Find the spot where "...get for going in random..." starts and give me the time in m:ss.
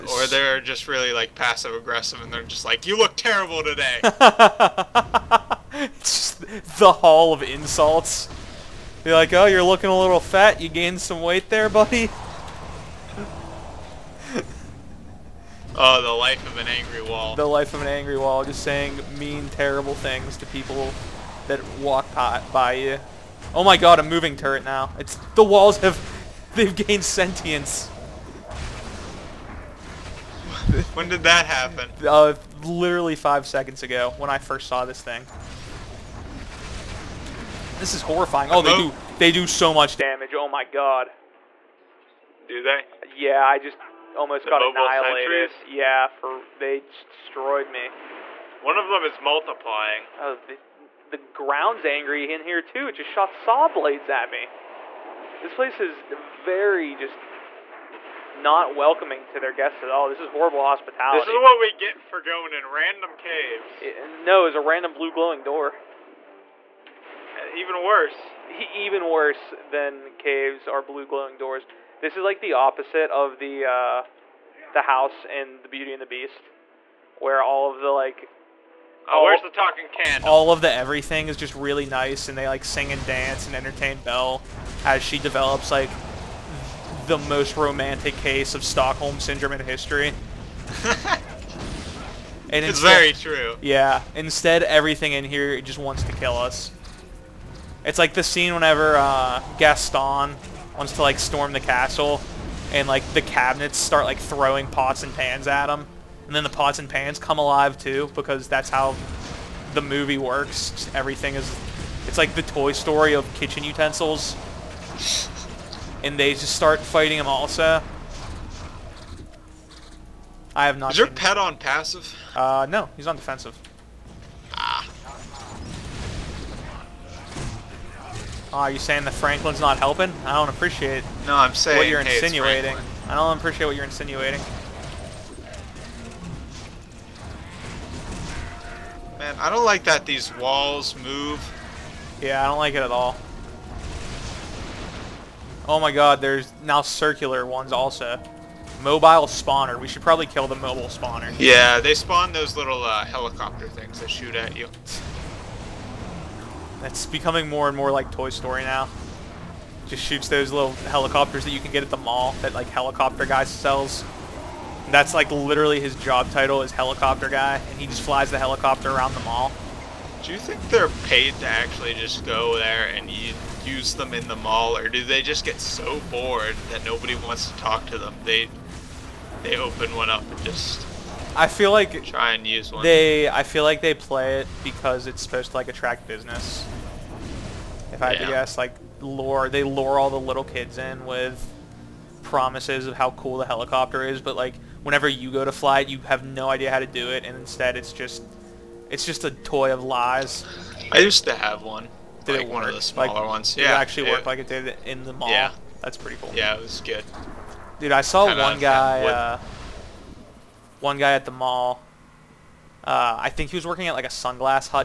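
1:01.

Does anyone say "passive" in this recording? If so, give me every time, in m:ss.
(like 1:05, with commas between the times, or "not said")
0:01, 2:01.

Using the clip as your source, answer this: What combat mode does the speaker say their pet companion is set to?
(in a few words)
Defensive.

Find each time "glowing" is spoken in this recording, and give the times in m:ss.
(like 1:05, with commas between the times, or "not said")
1:05, 1:11.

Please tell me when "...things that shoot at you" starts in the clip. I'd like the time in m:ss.
2:33.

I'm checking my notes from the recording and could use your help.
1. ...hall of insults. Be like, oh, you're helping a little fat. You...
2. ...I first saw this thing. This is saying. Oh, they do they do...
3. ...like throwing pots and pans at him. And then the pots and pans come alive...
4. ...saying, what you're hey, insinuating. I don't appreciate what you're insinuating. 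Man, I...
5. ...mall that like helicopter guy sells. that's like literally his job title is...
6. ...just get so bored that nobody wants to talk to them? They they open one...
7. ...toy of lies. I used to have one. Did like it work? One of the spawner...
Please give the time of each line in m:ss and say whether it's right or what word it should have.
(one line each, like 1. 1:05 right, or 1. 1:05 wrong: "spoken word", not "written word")
1. 0:06 wrong: "looking", not "helping"
2. 0:34 wrong: "horrifying", not "saying"
3. 1:44 right
4. 2:11 right
5. 2:41 right
6. 2:55 right
7. 3:19 wrong: "smaller", not "spawner".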